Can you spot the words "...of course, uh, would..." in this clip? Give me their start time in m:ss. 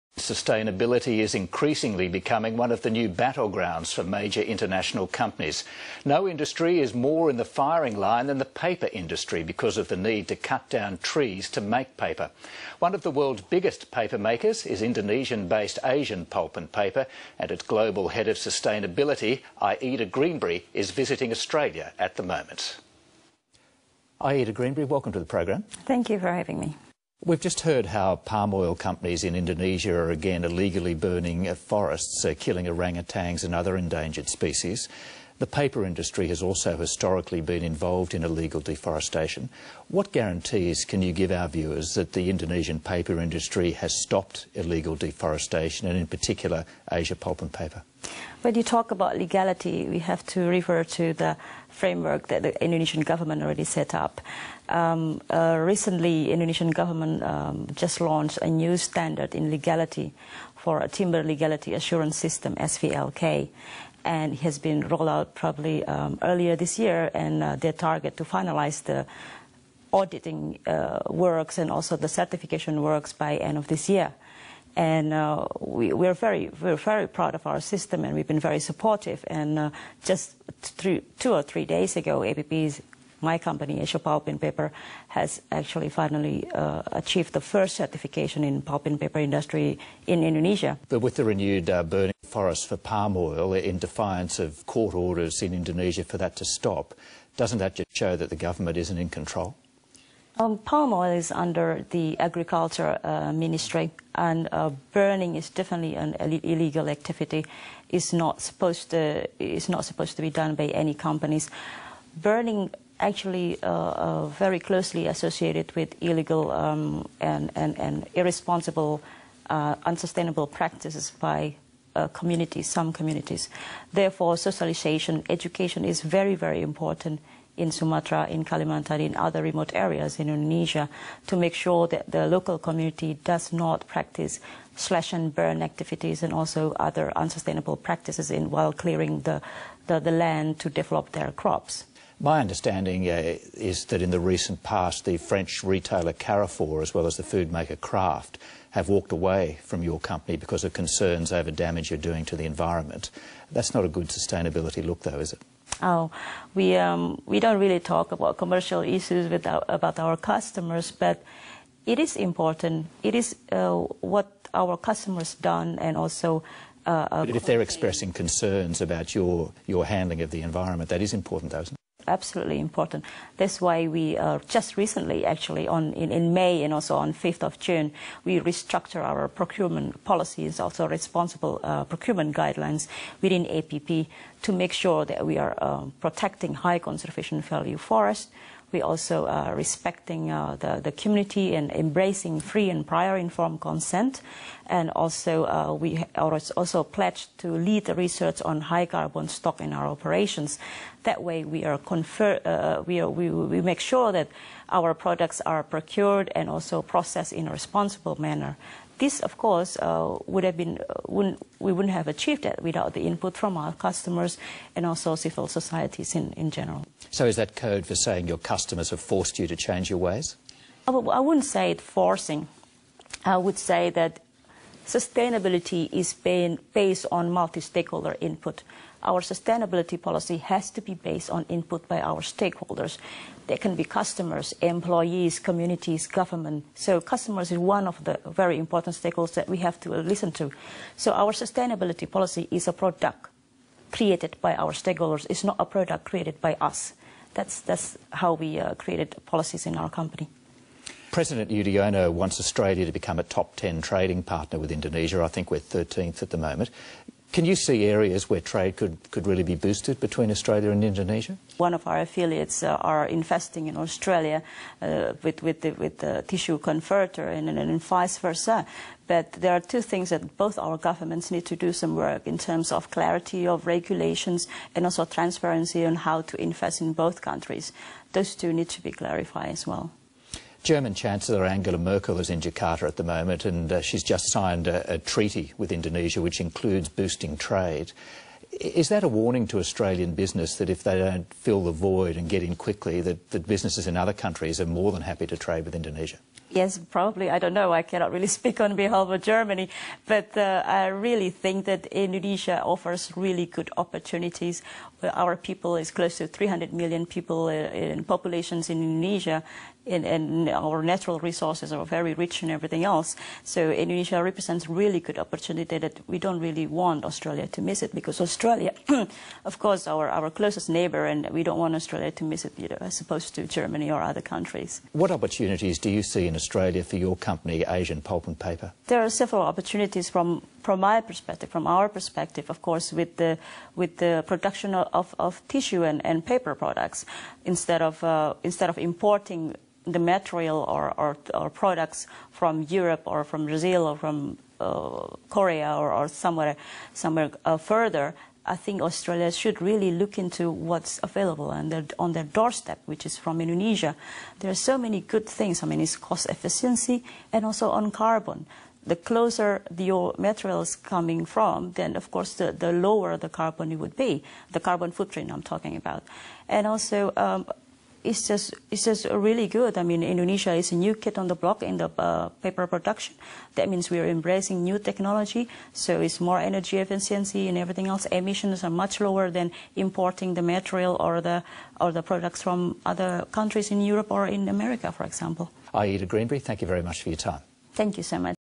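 3:29.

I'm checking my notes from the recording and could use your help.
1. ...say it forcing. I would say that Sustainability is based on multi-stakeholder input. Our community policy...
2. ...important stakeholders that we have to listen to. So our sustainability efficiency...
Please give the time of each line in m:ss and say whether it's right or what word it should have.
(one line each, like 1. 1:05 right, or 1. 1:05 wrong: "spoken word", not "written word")
1. 3:41 wrong: "sustainability", not "community"
2. 3:58 wrong: "policy", not "efficiency".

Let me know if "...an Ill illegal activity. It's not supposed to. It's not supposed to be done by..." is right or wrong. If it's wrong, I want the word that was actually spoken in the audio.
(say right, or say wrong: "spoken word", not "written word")
right.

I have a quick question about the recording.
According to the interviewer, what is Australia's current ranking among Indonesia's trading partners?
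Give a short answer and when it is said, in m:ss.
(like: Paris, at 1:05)
13th, at 4:15.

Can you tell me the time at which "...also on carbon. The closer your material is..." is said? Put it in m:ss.
5:57.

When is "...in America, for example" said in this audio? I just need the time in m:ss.
6:24.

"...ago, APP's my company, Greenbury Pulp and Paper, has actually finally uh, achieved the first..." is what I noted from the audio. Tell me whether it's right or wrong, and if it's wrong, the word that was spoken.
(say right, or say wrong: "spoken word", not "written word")
wrong: "Asia", not "Greenbury".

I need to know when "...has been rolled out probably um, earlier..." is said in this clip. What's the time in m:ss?
1:04.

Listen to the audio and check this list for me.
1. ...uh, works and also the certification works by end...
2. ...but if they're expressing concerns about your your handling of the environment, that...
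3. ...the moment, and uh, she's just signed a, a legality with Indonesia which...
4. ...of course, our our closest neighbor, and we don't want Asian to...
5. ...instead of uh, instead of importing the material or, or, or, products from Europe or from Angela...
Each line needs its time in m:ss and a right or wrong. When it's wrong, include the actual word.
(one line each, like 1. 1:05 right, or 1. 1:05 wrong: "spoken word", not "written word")
1. 1:10 right
2. 2:47 right
3. 4:42 wrong: "treaty", not "legality"
4. 5:19 wrong: "Australia", not "Asian"
5. 5:37 wrong: "Brazil", not "Angela".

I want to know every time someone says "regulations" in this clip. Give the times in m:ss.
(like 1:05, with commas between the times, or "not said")
4:33.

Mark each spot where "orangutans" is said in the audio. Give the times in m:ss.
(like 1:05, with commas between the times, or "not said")
0:32.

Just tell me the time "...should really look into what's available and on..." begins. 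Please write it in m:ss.
5:49.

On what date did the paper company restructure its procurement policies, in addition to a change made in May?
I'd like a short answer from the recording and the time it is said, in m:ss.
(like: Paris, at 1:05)
5 June, at 2:57.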